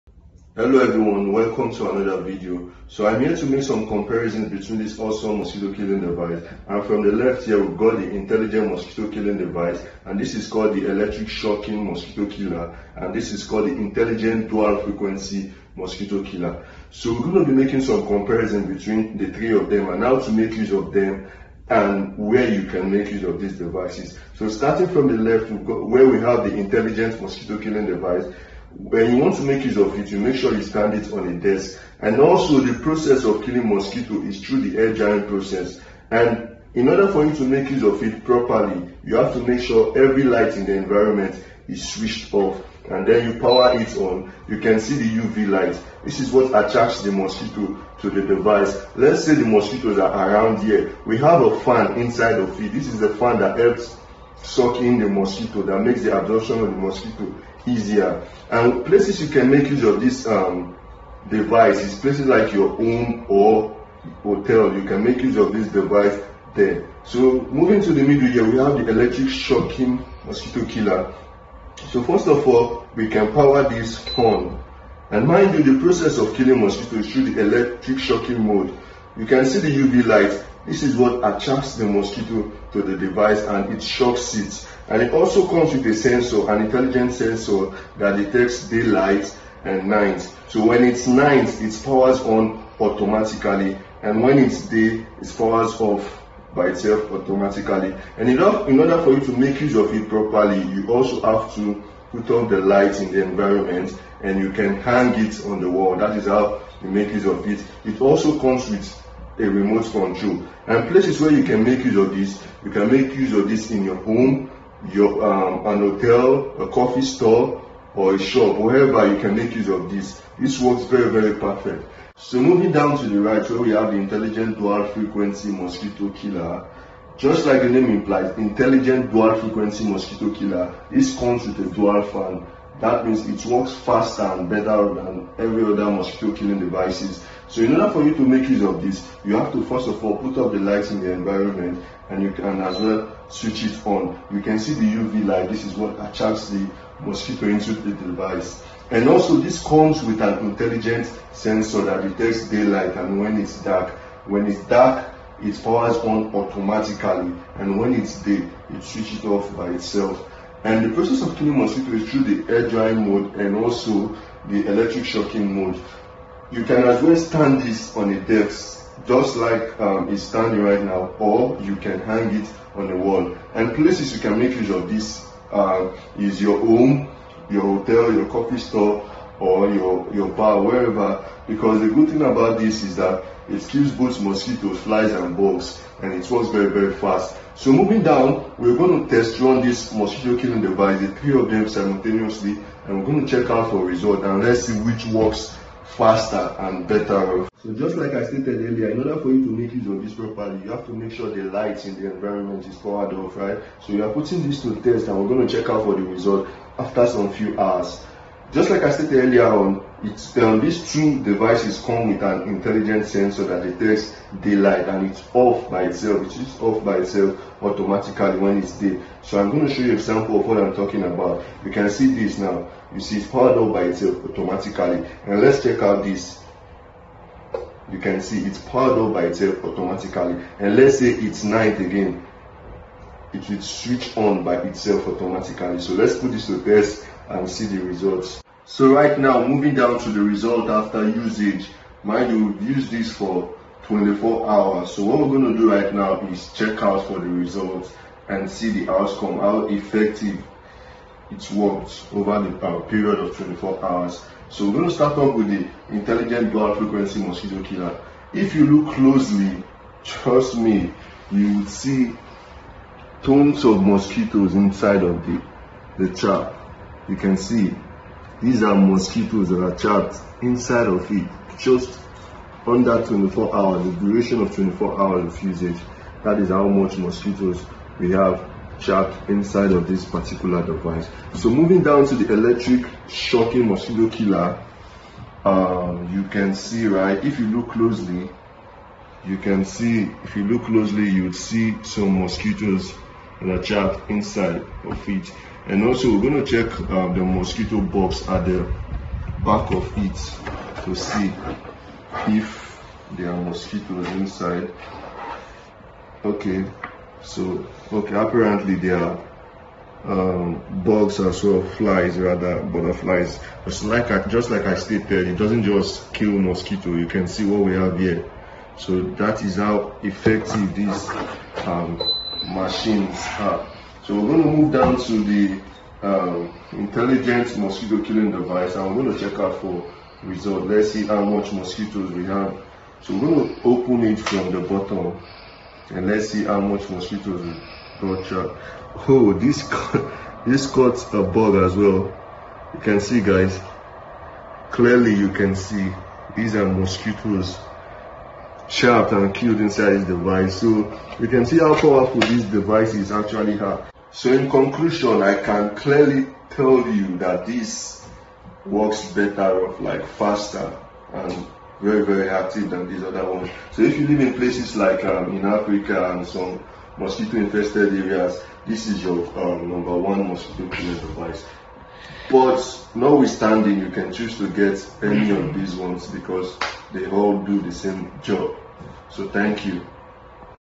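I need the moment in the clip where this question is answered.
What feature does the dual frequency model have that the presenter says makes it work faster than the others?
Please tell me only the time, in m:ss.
2:11.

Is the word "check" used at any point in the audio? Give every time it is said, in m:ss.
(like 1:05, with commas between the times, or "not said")
3:13, 3:25, 3:45, 4:06, 4:56, 5:29.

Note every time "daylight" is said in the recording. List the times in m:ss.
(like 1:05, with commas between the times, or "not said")
1:28, 2:32, 3:34.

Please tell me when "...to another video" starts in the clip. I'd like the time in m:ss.
0:01.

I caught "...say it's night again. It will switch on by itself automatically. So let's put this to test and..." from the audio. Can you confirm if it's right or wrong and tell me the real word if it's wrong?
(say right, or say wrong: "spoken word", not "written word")
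right.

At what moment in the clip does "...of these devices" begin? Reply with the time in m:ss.
0:23.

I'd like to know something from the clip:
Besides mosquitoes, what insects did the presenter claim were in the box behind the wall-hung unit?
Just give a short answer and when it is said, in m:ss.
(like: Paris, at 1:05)
butterflies, at 5:12.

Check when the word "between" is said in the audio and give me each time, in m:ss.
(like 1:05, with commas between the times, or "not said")
0:04, 0:18.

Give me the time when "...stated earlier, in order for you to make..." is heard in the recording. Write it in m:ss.
3:18.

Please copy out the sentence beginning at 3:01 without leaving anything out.
Because the good thing about this is that it kills both mosquitoes, flies, and bugs, and it works very, very fast.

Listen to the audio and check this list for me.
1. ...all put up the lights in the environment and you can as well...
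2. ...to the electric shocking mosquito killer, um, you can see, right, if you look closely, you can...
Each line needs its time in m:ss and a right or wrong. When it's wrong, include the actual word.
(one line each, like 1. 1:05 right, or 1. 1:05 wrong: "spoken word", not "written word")
1. 2:20 right
2. 4:42 right.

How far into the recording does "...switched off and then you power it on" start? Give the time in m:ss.
0:41.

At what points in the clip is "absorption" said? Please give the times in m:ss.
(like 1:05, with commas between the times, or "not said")
0:56.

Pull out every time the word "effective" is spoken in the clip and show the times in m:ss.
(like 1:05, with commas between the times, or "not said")
4:09, 5:20.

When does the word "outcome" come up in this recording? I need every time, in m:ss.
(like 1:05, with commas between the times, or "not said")
4:08.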